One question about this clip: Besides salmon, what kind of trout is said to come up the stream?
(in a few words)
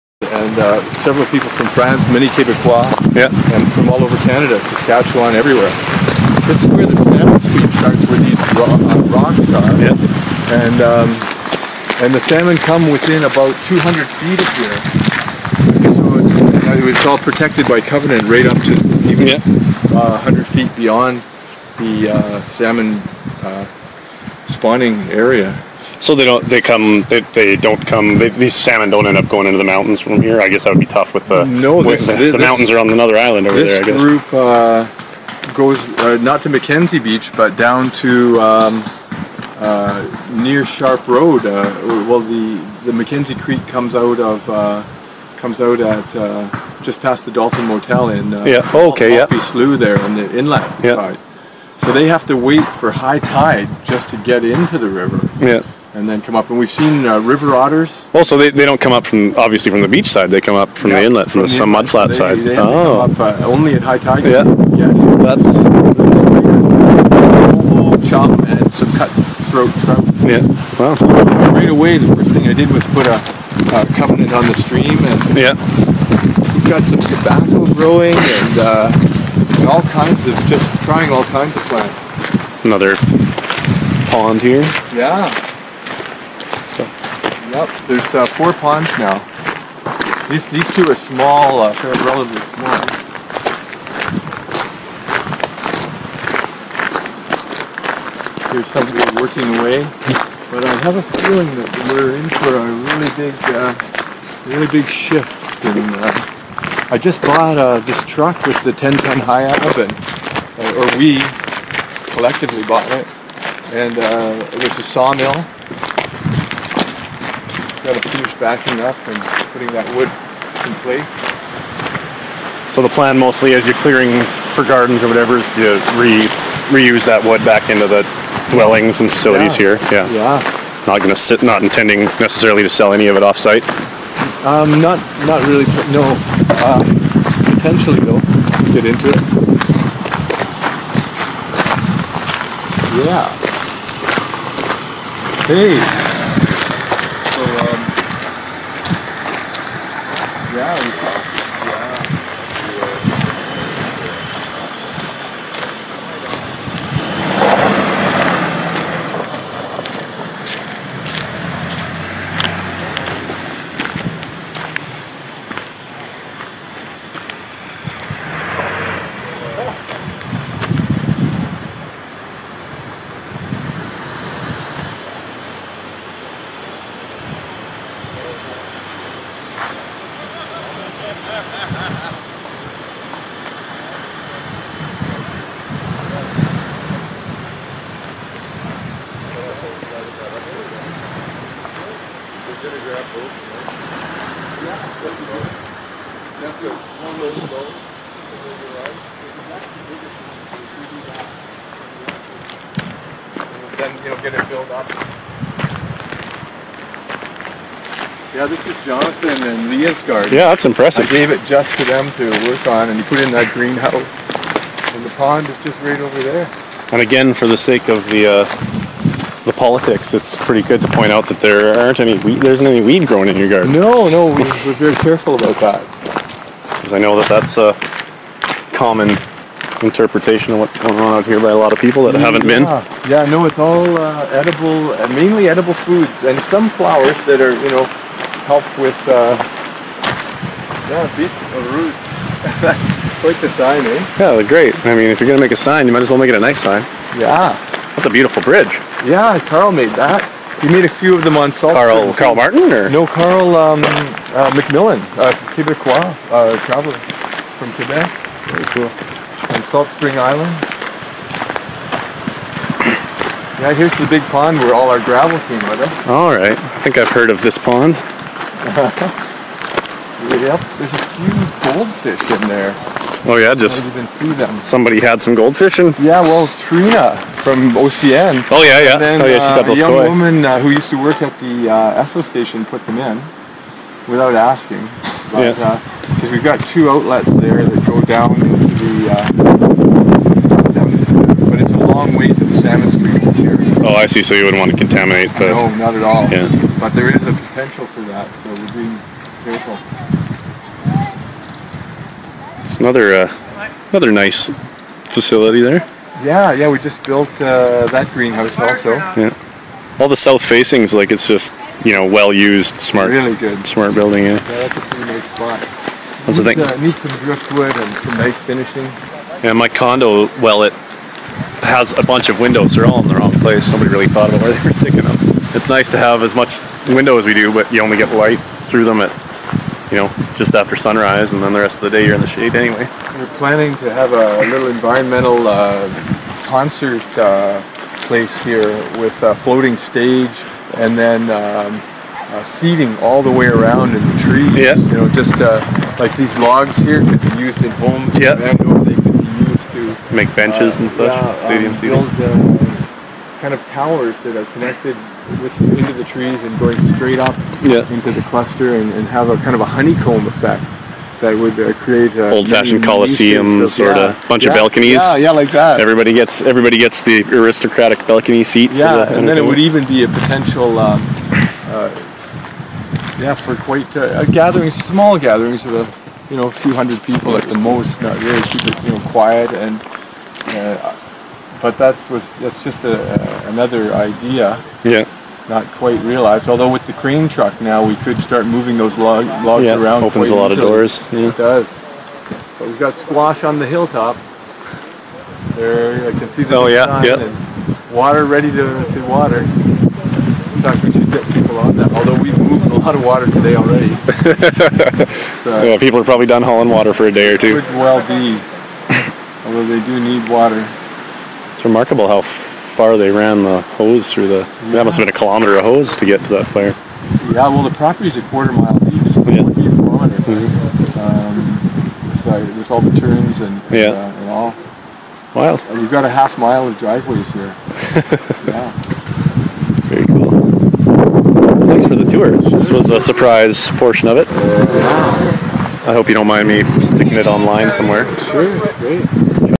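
Cutthroat trout.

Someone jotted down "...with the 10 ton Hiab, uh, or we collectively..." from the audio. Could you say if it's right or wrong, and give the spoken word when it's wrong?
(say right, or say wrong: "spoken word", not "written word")
right.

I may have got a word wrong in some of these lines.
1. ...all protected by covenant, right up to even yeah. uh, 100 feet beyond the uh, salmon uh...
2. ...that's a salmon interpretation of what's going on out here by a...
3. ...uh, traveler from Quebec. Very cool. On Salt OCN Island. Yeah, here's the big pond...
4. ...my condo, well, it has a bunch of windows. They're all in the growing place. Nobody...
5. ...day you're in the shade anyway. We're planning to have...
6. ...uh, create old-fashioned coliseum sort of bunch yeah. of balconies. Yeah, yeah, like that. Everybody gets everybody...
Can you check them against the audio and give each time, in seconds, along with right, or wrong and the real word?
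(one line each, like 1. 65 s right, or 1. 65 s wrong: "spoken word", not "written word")
1. 17 s right
2. 227 s wrong: "common", not "salmon"
3. 256 s wrong: "Spring", not "OCN"
4. 319 s wrong: "wrong", not "growing"
5. 331 s right
6. 361 s right.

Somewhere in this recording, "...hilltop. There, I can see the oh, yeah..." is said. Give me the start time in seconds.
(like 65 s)
393 s.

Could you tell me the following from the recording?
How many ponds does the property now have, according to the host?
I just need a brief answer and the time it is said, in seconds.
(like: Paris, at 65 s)
4, at 88 s.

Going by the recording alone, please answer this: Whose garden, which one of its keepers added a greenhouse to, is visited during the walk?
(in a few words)
Jonathan and Leah's.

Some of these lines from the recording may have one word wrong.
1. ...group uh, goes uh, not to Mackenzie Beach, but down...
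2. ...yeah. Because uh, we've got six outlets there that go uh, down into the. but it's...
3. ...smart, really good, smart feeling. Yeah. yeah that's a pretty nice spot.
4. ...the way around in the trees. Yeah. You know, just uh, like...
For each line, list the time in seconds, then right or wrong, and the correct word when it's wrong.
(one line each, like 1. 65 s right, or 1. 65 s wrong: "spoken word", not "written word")
1. 34 s right
2. 285 s wrong: "two", not "six"
3. 312 s wrong: "building", not "feeling"
4. 343 s right.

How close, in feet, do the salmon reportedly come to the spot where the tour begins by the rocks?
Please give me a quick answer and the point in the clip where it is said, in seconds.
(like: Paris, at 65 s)
200 feet, at 13 s.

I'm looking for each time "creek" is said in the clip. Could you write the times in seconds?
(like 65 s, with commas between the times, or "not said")
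43 s, 292 s.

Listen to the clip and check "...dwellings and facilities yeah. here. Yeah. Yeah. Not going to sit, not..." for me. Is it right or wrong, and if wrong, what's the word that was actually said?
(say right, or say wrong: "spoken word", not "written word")
right.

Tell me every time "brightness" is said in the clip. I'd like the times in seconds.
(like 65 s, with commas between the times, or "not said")
not said.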